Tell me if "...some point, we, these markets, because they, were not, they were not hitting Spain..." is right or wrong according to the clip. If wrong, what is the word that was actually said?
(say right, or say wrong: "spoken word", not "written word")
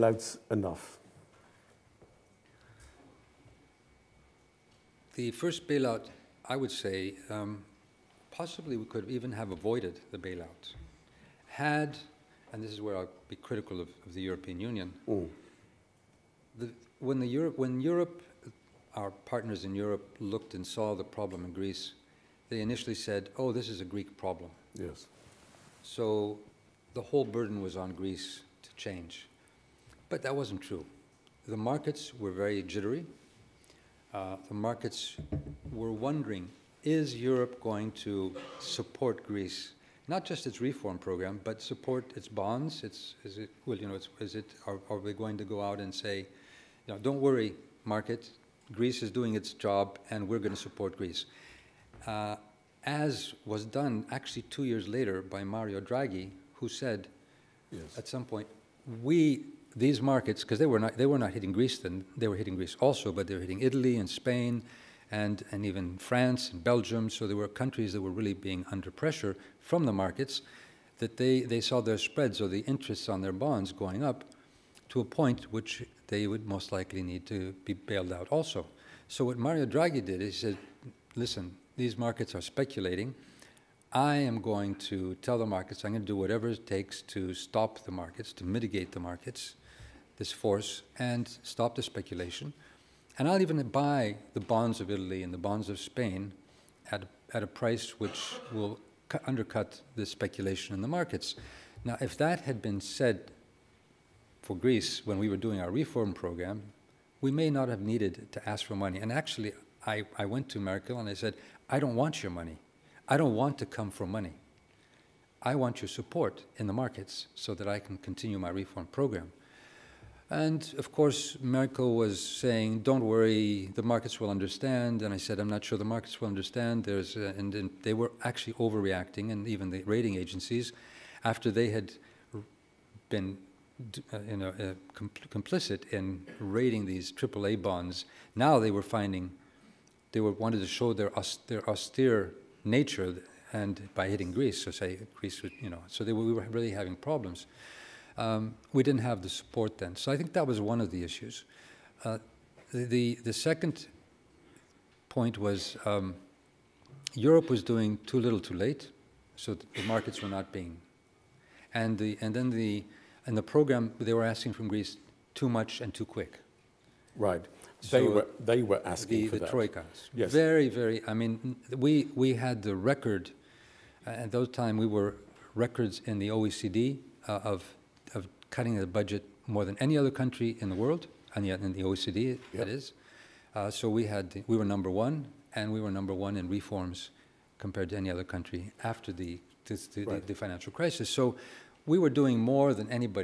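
wrong: "Greece", not "Spain".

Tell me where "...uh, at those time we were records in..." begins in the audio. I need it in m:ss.
2:54.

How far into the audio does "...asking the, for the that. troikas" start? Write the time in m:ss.
2:48.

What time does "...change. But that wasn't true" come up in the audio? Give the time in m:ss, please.
0:28.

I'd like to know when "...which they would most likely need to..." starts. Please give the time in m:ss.
1:15.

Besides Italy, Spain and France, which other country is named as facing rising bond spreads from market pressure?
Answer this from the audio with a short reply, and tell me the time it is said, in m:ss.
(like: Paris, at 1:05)
Belgium, at 1:06.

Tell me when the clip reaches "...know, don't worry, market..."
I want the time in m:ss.
0:46.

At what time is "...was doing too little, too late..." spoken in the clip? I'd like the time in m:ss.
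2:37.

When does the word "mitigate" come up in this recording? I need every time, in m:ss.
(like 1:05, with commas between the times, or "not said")
1:28.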